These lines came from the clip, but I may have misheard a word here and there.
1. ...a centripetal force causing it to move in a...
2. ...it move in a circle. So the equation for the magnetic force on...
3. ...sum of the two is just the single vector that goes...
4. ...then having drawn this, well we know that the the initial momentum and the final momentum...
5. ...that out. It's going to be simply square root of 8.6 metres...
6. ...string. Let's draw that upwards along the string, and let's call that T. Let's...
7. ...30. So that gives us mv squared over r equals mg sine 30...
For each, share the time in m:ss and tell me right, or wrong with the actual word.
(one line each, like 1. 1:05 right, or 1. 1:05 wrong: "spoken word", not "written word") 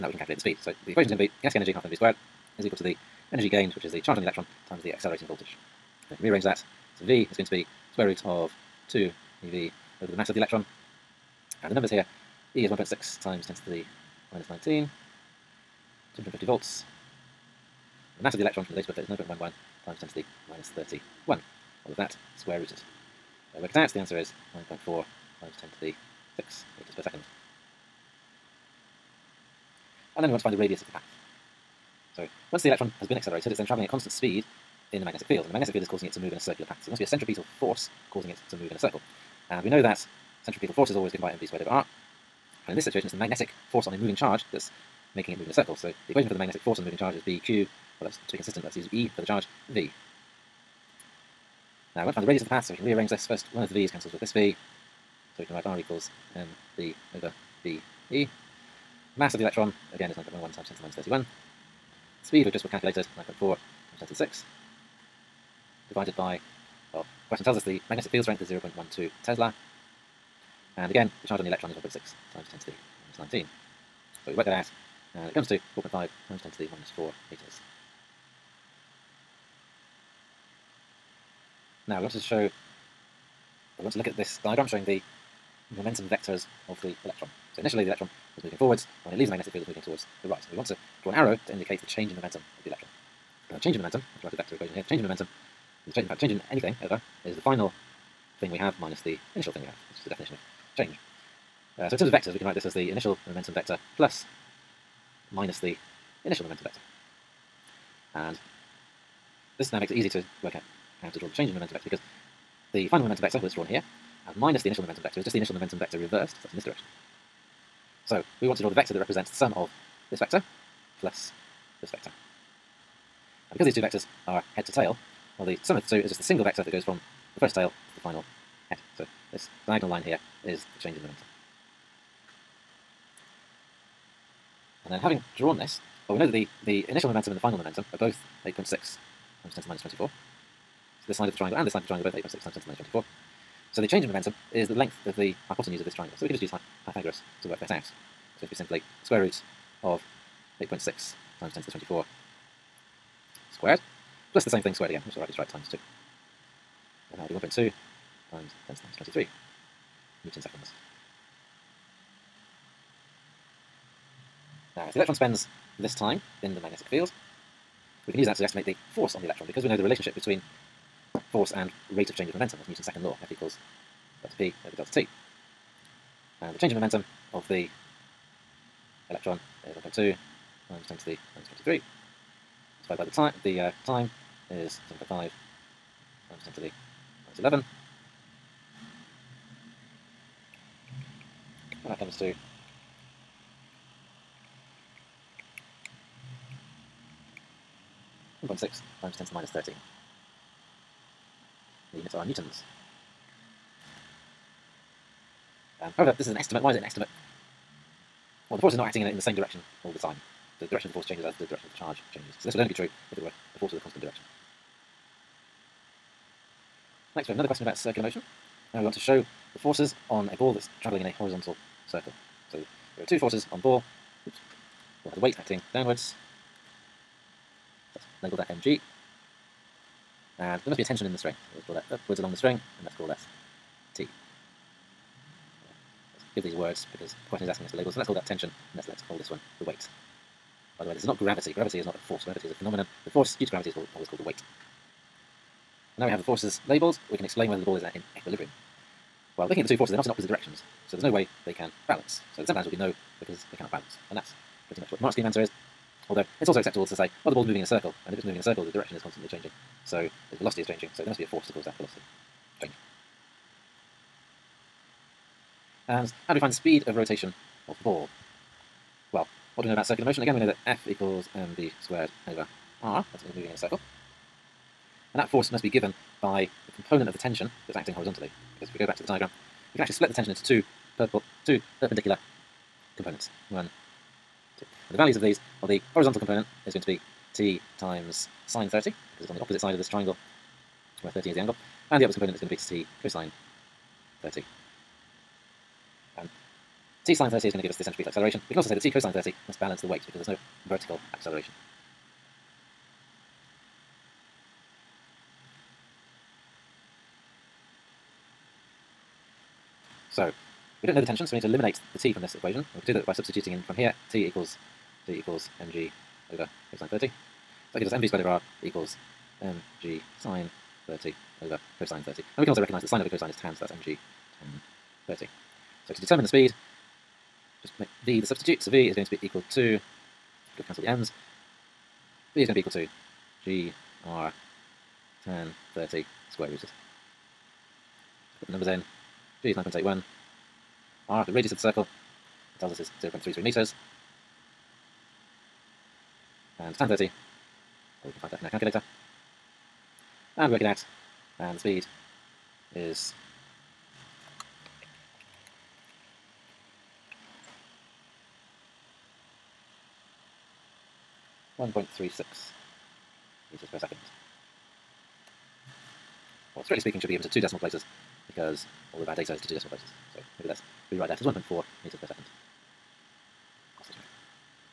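1. 0:37 right
2. 0:45 right
3. 2:05 right
4. 2:14 right
5. 2:27 wrong: "times", not "metres"
6. 3:51 right
7. 5:16 right.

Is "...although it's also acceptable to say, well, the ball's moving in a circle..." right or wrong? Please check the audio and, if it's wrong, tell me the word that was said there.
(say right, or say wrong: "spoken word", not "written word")
right.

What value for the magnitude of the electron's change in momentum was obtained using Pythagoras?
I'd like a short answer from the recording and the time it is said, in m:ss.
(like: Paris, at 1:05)
1.2 x 10^-23 N s, at 2:37.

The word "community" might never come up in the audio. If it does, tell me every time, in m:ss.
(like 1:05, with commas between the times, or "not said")
not said.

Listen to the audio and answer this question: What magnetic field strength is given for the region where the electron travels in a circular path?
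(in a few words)
0.12 tesla.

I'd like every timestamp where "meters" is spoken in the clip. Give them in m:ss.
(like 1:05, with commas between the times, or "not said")
1:17, 5:43, 6:03, 6:11.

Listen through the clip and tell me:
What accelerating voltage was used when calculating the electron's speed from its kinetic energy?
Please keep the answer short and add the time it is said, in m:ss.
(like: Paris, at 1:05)
250 volts, at 0:16.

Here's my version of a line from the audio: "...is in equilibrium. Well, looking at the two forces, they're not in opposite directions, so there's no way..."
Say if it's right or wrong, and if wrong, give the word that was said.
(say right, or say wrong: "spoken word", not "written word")
right.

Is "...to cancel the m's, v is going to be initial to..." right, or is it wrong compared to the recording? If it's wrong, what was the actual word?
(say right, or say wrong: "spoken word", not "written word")
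wrong: "equal", not "initial".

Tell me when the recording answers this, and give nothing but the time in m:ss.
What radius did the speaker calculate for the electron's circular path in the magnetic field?
1:15.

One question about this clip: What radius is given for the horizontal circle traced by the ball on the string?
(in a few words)
0.33 metres.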